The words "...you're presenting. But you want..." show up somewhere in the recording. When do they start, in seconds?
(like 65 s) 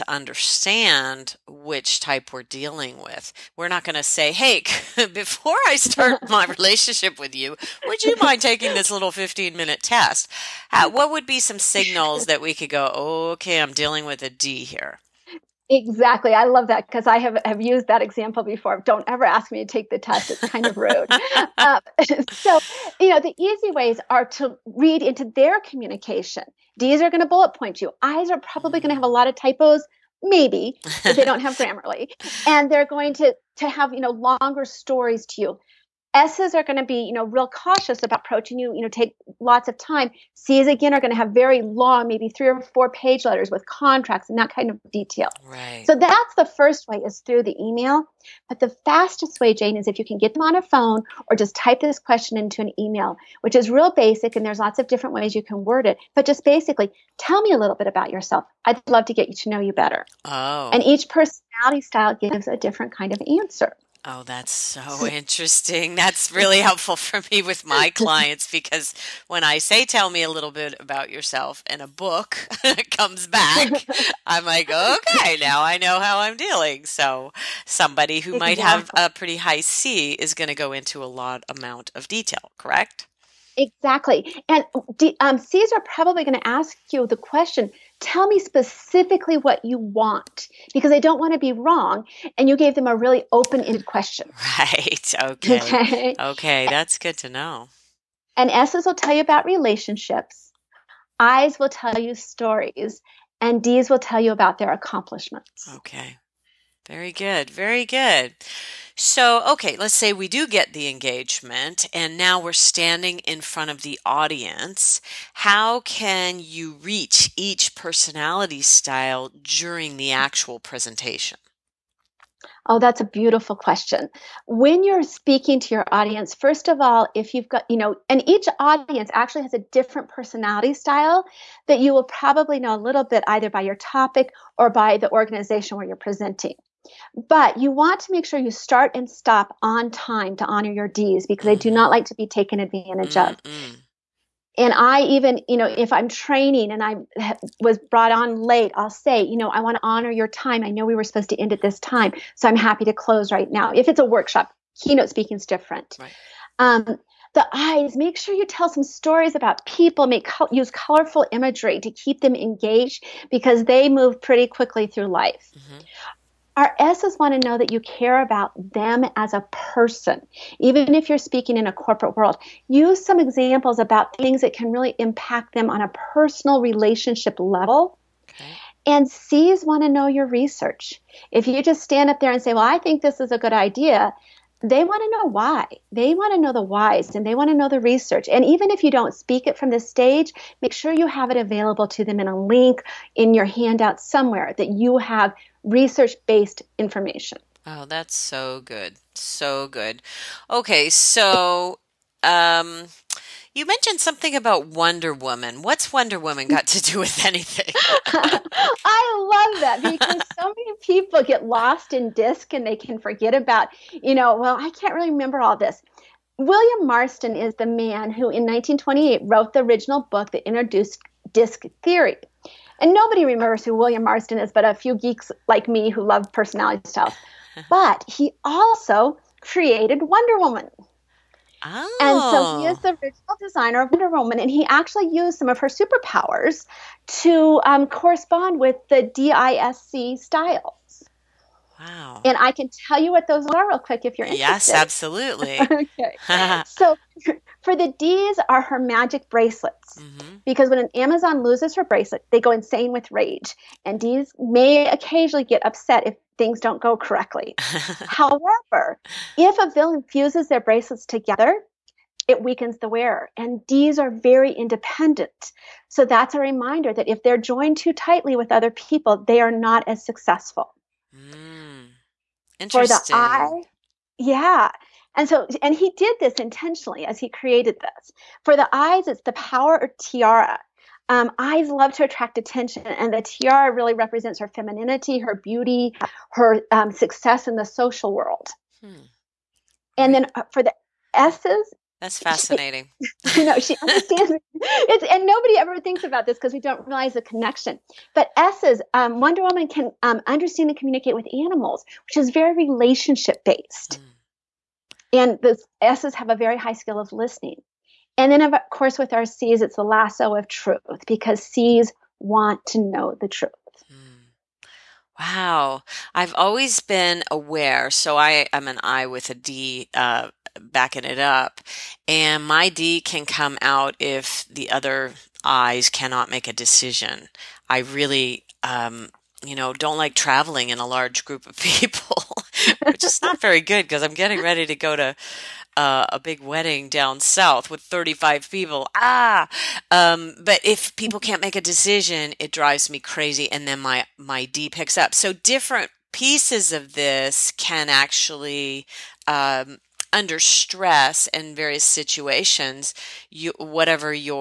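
135 s.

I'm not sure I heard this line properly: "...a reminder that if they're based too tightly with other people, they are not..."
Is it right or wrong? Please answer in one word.
wrong.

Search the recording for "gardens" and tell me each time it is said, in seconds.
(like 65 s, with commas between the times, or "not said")
not said.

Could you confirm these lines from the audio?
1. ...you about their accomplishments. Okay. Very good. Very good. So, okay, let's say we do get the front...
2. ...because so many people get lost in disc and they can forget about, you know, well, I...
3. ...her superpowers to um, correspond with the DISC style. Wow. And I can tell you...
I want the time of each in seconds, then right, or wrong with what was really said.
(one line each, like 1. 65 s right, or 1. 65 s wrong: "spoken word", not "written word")
1. 104 s wrong: "engagement", not "front"
2. 209 s right
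3. 235 s right.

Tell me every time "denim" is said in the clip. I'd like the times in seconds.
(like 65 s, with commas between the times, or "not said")
not said.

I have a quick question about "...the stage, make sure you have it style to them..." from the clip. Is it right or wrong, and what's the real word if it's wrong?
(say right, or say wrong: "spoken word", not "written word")
wrong: "available", not "style".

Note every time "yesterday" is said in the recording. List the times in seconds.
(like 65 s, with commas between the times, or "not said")
not said.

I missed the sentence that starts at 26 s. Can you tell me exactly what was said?
D's are going to bullet point you.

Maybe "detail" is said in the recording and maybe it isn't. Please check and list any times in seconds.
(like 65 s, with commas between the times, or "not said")
44 s, 82 s.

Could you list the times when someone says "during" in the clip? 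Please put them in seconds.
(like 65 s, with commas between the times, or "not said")
119 s.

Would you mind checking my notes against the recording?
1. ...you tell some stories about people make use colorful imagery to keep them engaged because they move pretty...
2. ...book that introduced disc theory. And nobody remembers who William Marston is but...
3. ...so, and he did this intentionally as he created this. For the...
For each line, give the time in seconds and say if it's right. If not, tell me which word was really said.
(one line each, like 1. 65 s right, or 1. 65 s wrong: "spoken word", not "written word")
1. 158 s right
2. 220 s right
3. 275 s right.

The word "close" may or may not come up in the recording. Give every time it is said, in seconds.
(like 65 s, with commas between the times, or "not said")
152 s.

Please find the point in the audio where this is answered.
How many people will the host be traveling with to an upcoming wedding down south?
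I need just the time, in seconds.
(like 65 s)
337 s.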